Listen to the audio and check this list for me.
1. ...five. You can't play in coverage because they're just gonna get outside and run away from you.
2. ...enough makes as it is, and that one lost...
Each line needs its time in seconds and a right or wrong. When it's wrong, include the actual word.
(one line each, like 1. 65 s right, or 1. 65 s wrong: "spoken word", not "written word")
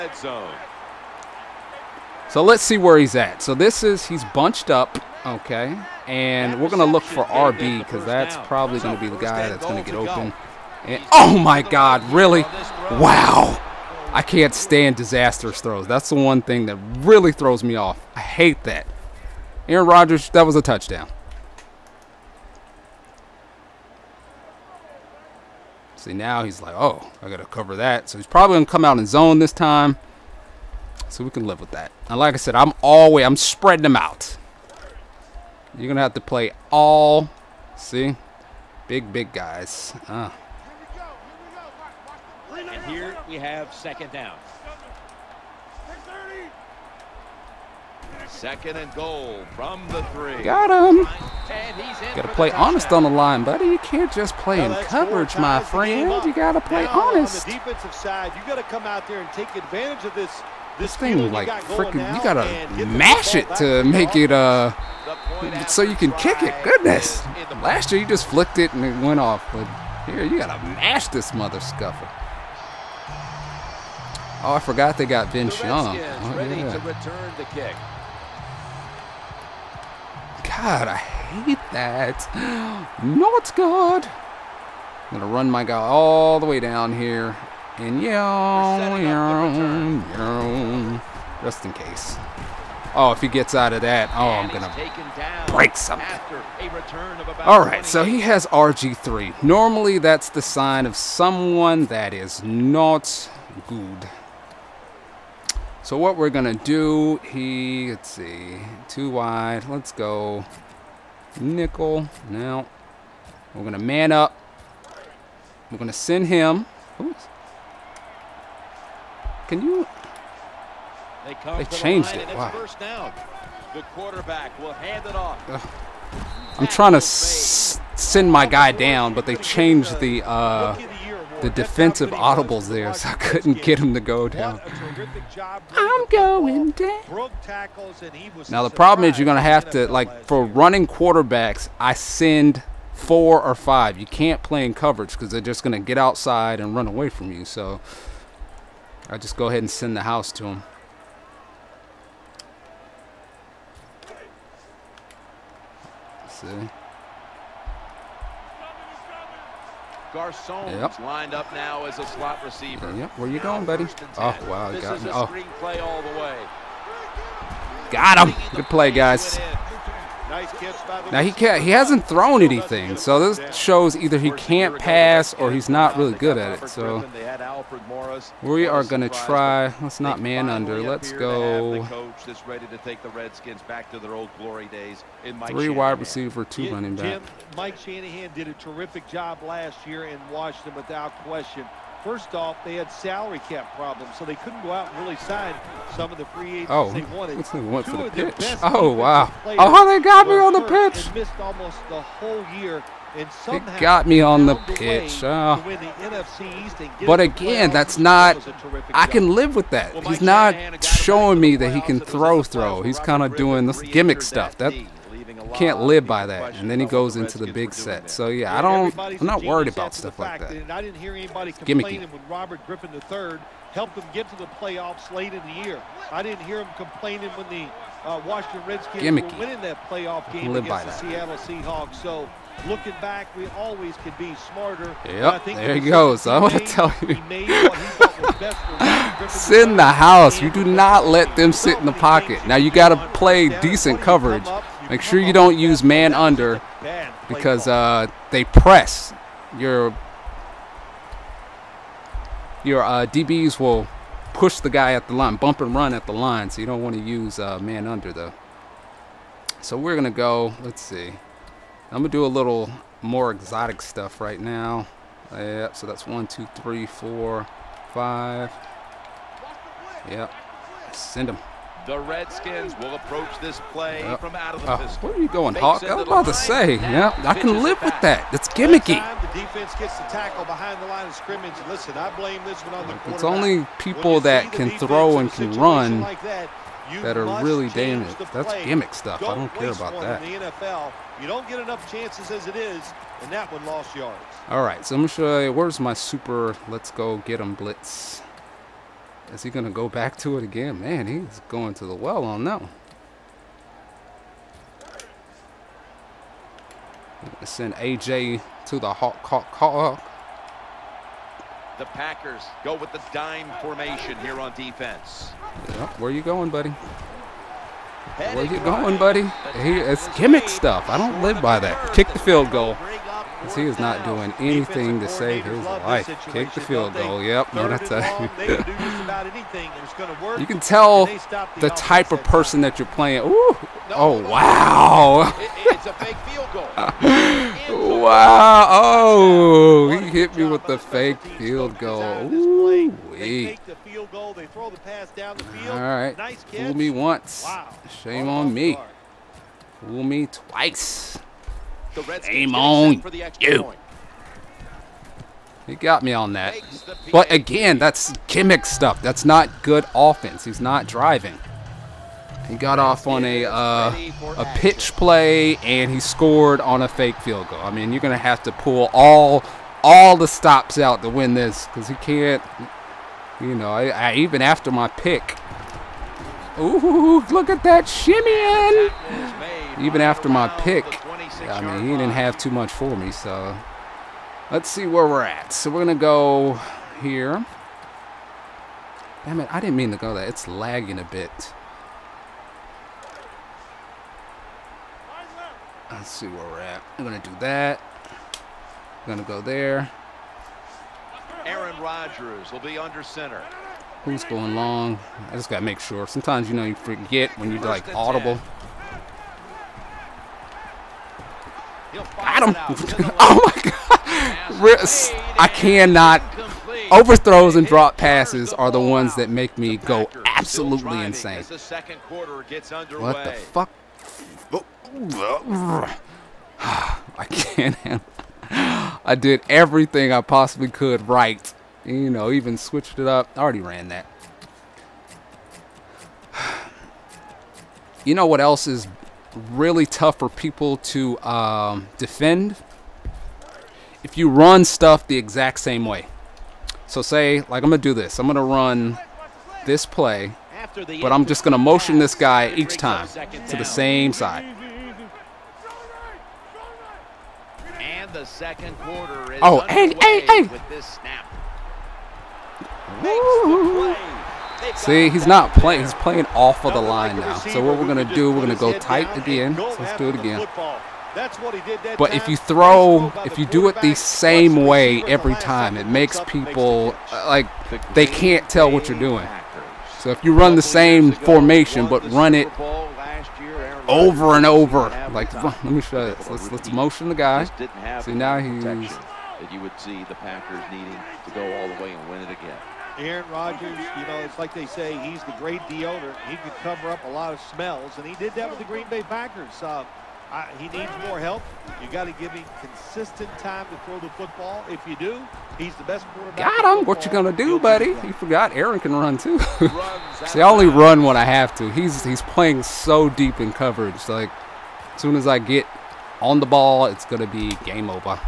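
1. 143 s right
2. 291 s wrong: "chances", not "makes".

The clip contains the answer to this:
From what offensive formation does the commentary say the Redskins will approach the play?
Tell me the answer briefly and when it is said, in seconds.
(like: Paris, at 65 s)
Pistol, at 274 s.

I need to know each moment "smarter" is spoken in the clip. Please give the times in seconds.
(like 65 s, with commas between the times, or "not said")
234 s.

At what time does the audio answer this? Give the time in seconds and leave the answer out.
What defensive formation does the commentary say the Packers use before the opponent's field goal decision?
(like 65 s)
313 s.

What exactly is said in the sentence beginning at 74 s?
Oh, I forgot they got Vince the Young.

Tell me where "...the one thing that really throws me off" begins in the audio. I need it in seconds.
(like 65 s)
16 s.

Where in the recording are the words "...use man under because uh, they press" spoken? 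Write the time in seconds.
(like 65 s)
245 s.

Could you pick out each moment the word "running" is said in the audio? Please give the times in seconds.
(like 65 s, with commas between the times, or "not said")
140 s, 186 s.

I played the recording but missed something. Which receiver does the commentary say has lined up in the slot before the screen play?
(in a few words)
Garcon.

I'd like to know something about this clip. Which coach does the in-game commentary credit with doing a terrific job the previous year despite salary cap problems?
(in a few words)
Mike Shanahan.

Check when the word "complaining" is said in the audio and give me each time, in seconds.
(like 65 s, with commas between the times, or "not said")
221 s, 226 s.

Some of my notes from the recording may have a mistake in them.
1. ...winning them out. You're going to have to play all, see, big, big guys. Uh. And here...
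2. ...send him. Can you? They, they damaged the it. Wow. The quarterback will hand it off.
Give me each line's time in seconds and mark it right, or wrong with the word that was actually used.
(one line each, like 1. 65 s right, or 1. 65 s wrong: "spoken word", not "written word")
1. 33 s wrong: "spreading", not "winning"
2. 115 s wrong: "changed", not "damaged".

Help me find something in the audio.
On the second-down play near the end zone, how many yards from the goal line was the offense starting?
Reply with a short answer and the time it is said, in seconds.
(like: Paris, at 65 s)
3, at 48 s.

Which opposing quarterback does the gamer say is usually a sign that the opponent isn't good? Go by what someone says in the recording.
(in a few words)
RG3.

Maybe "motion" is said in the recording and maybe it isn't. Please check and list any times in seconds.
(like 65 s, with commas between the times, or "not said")
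451 s, 486 s.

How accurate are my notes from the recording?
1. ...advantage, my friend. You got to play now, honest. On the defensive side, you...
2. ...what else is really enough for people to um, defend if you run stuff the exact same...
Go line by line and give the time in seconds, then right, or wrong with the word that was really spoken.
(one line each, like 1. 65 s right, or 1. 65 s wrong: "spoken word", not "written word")
1. 54 s wrong: "coverage", not "advantage"
2. 438 s wrong: "tough", not "enough".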